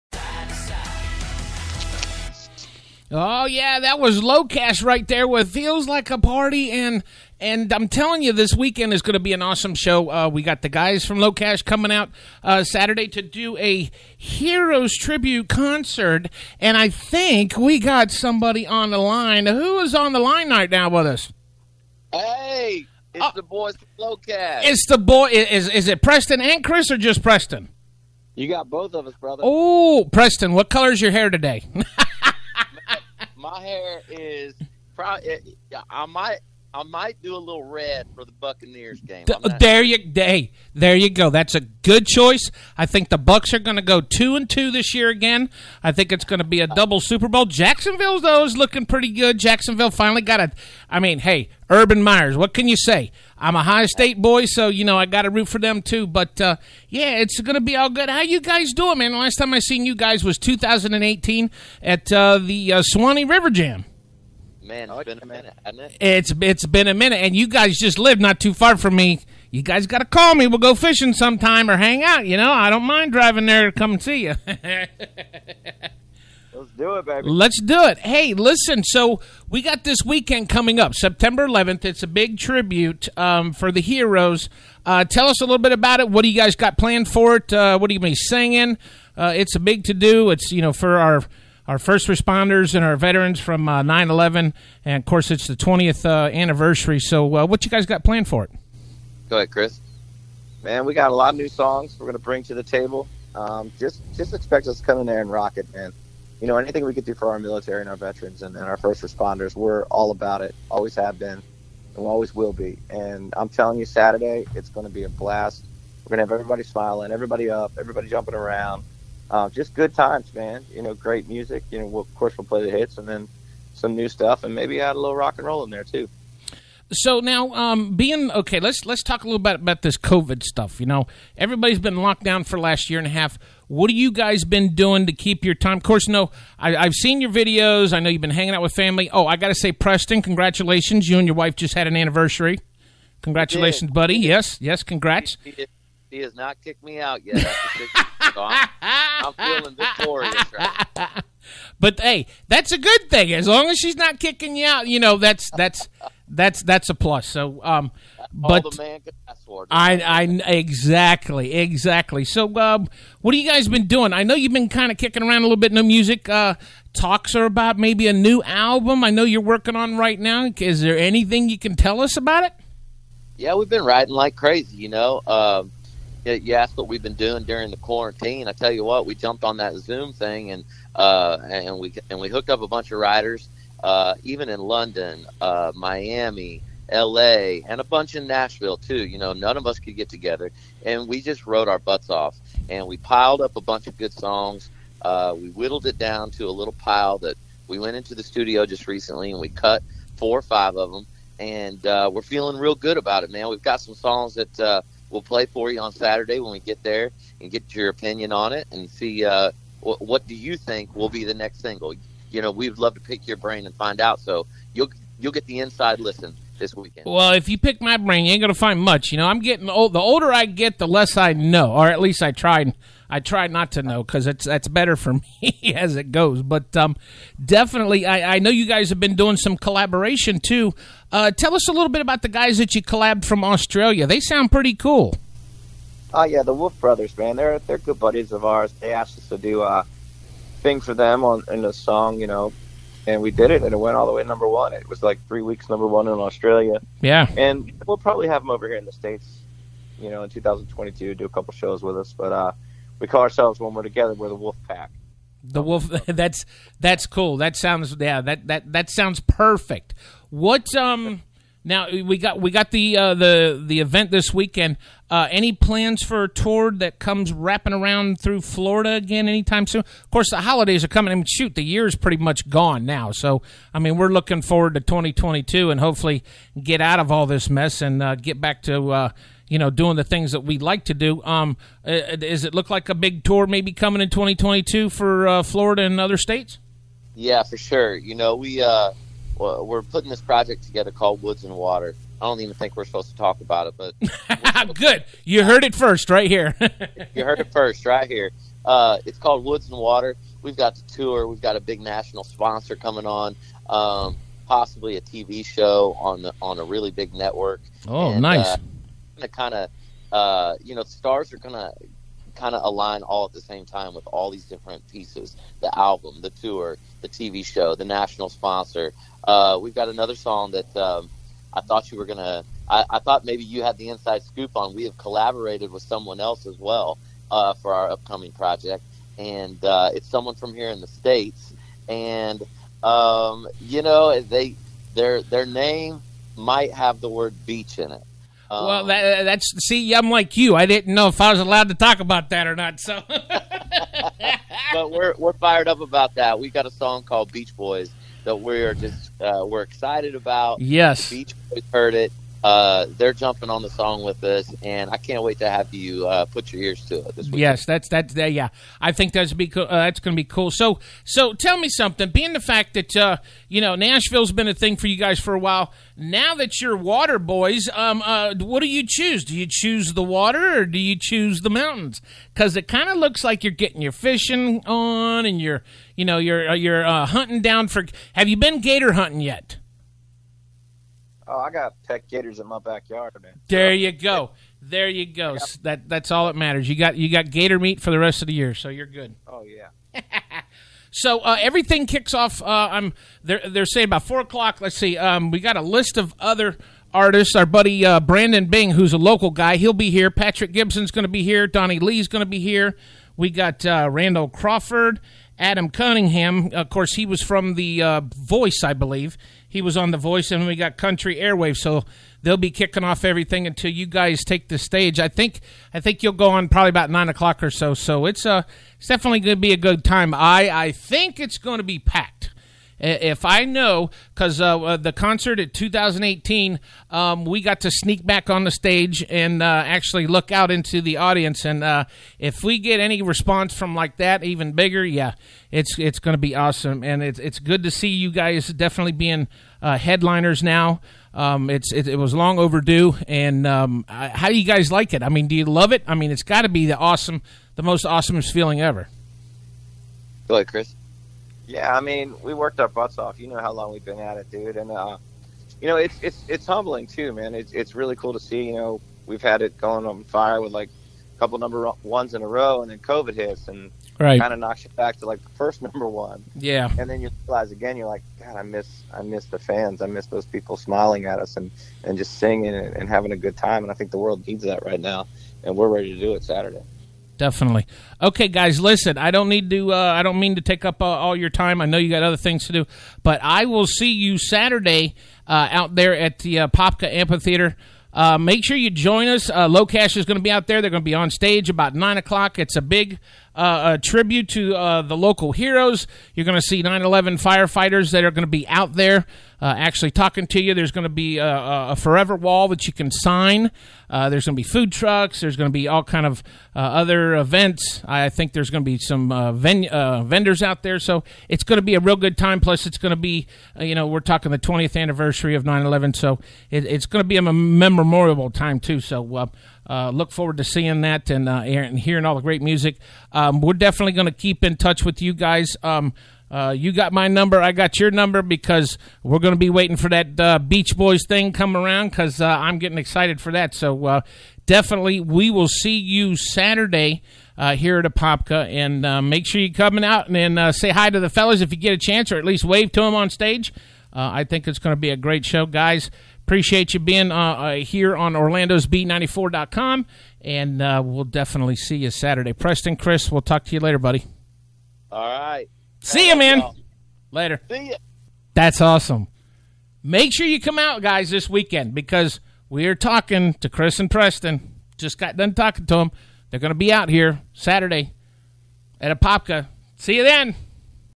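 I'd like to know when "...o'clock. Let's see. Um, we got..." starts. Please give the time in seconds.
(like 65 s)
394 s.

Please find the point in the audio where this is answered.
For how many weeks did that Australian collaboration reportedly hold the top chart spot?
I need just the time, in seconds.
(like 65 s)
245 s.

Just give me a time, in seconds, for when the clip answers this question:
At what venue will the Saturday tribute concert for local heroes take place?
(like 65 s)
486 s.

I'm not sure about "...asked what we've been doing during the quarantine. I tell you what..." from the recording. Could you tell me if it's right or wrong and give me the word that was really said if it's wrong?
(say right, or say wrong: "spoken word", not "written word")
right.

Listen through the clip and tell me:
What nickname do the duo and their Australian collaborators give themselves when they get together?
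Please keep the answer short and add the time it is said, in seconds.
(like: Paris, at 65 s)
the Wolf Pack, at 254 s.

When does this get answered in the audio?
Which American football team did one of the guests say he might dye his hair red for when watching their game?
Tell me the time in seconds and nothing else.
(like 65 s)
38 s.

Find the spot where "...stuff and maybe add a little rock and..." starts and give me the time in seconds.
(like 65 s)
124 s.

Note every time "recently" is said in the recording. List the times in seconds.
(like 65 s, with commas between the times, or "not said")
198 s.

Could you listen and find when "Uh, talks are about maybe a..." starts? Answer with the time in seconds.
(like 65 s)
166 s.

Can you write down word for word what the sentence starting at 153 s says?
As long as she's not kicking you out, you know that's that's that's that's a plus.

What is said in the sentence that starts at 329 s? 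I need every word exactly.
And uh, it's someone from here in the States.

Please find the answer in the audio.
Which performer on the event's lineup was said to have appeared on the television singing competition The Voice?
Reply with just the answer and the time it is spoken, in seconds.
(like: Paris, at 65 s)
Adam Cunningham, at 405 s.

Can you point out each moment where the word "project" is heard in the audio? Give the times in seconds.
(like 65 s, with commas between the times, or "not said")
290 s, 328 s.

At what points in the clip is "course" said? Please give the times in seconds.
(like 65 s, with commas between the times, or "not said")
95 s, 122 s, 135 s, 270 s, 406 s.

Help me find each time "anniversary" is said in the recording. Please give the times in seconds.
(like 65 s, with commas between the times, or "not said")
96 s, 141 s, 514 s.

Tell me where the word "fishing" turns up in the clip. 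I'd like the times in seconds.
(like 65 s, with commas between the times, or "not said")
70 s, 373 s.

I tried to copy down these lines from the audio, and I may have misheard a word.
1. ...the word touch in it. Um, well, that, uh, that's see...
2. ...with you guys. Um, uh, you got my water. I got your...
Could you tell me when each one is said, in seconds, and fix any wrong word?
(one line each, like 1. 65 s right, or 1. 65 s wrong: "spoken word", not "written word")
1. 337 s wrong: "beach", not "touch"
2. 524 s wrong: "number", not "water".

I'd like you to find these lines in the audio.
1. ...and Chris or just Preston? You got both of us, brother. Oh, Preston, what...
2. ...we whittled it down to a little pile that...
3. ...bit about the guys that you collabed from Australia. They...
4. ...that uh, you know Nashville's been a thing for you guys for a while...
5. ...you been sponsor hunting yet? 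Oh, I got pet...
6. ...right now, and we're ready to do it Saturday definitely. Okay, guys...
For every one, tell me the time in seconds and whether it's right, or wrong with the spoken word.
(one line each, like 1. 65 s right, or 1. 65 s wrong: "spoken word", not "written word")
1. 26 s right
2. 195 s right
3. 231 s right
4. 362 s right
5. 378 s wrong: "gator", not "sponsor"
6. 474 s right.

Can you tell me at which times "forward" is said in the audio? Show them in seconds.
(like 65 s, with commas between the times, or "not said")
274 s, 520 s.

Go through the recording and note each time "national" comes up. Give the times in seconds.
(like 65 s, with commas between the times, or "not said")
301 s, 317 s.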